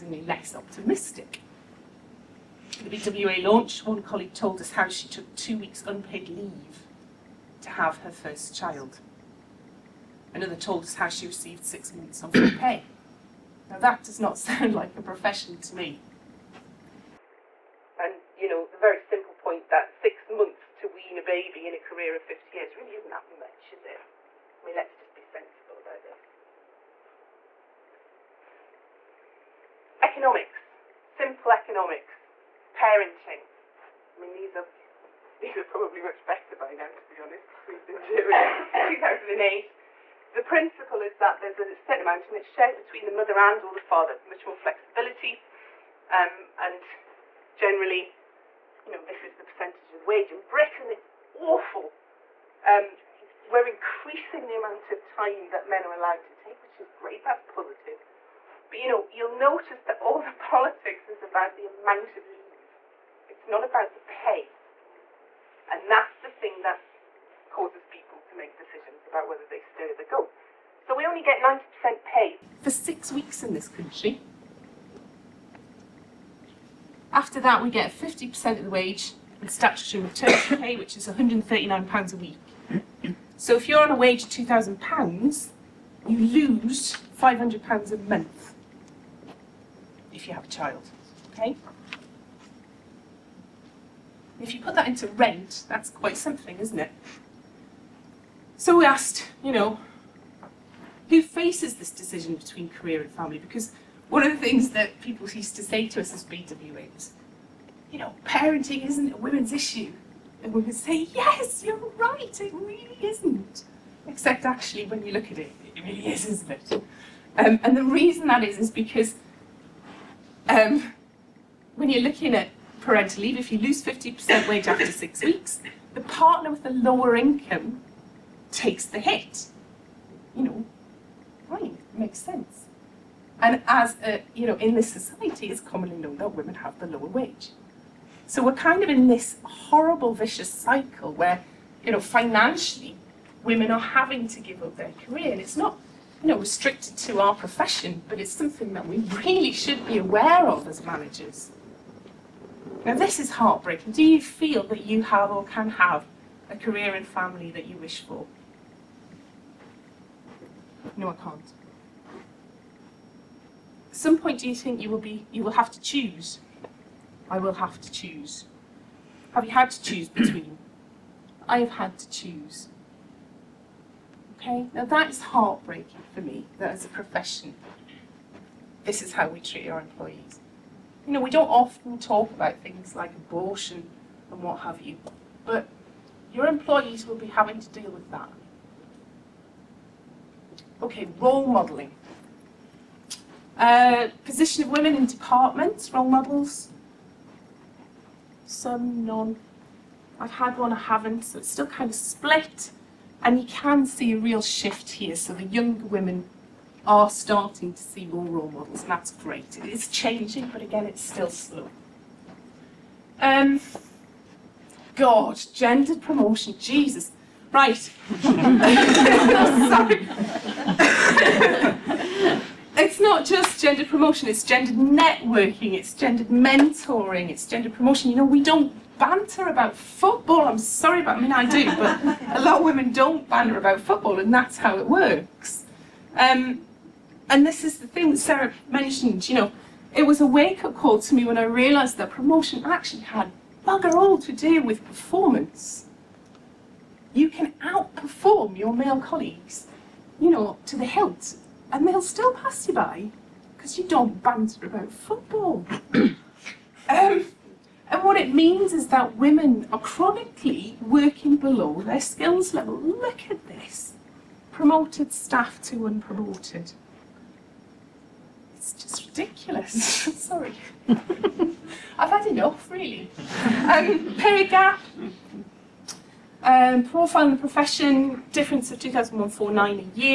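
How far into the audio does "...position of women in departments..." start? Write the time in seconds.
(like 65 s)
194 s.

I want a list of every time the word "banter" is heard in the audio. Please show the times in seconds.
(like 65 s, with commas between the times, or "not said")
228 s, 233 s, 254 s.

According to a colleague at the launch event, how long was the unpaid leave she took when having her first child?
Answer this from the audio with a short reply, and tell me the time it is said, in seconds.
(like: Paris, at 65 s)
2 weeks, at 5 s.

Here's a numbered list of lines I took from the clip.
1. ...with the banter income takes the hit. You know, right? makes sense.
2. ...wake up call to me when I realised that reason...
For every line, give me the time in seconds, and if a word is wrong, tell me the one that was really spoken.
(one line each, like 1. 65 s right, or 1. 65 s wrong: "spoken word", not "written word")
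1. 126 s wrong: "lower", not "banter"
2. 240 s wrong: "promotion", not "reason".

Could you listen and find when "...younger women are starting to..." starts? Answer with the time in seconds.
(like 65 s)
205 s.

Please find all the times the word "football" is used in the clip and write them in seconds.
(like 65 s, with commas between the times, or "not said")
229 s, 233 s, 254 s.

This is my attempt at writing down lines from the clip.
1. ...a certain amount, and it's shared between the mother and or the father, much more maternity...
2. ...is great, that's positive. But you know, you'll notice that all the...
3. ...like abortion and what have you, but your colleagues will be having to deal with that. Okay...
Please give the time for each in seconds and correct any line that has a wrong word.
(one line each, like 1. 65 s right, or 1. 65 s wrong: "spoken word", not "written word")
1. 41 s wrong: "flexibility", not "maternity"
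2. 56 s right
3. 182 s wrong: "employees", not "colleagues".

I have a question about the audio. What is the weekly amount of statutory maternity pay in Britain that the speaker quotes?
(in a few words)
£139.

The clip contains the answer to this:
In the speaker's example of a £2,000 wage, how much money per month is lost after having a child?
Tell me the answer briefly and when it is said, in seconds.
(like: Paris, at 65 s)
£500, at 87 s.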